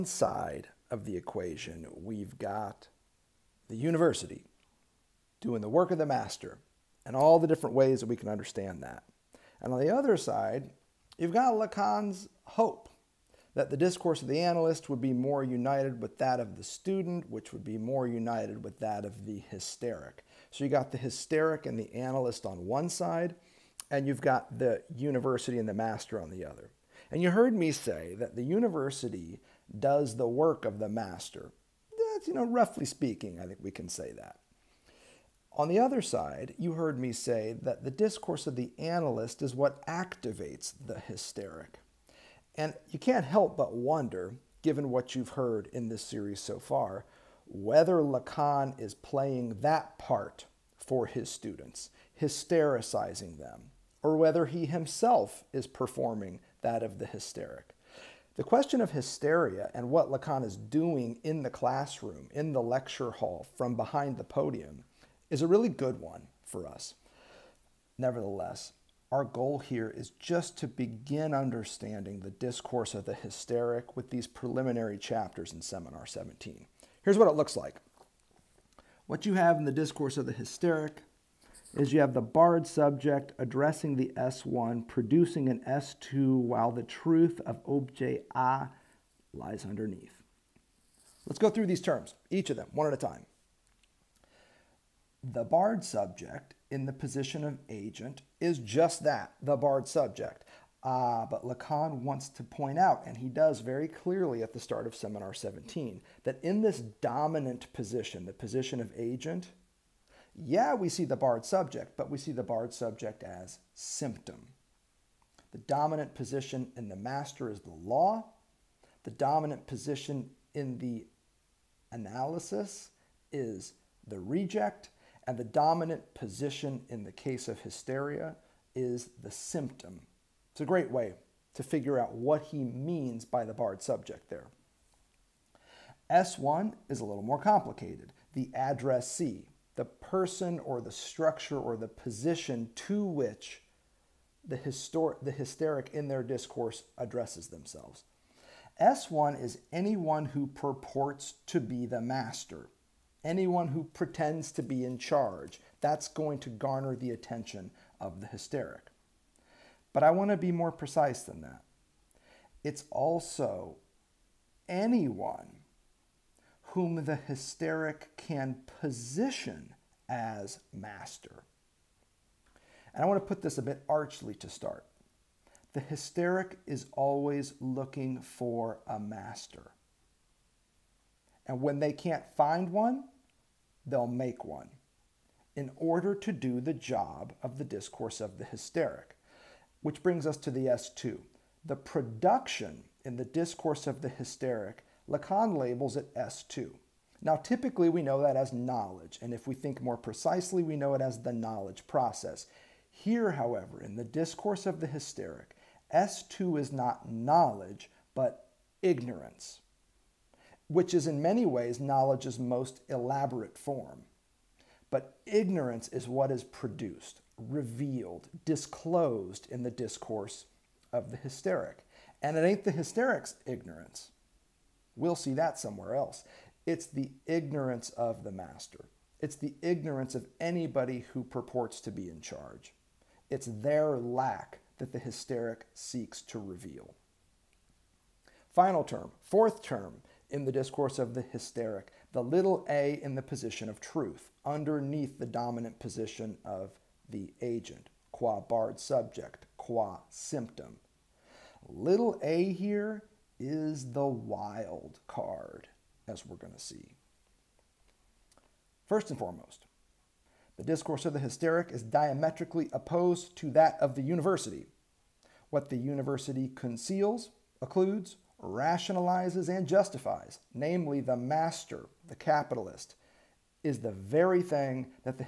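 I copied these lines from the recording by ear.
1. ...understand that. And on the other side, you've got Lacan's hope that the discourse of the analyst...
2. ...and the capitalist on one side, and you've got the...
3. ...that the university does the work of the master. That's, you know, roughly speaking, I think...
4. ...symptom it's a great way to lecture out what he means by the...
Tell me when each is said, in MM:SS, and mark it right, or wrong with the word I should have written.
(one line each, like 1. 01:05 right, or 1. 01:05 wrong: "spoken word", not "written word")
1. 00:08 right
2. 00:21 wrong: "analyst", not "capitalist"
3. 00:28 right
4. 02:09 wrong: "figure", not "lecture".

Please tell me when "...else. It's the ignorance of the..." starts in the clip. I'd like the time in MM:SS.
03:45.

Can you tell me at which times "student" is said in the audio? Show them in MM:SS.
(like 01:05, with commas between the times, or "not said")
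00:16, 00:51.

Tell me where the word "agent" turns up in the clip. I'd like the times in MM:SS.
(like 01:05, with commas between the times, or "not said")
01:37, 01:48, 04:07.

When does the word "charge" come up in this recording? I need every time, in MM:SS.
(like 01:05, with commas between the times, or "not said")
02:34, 03:52.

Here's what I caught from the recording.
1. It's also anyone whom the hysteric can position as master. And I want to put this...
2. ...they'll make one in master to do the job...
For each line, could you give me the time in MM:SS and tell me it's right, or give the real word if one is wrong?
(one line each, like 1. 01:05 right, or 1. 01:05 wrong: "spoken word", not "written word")
1. 02:42 right
2. 03:03 wrong: "order", not "master".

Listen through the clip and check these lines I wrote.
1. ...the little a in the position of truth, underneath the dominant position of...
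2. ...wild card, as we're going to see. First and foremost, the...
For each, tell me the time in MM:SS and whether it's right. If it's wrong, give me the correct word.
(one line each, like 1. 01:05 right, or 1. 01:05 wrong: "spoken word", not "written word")
1. 04:02 right
2. 04:14 right.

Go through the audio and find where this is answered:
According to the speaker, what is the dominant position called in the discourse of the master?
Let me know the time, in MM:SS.
01:57.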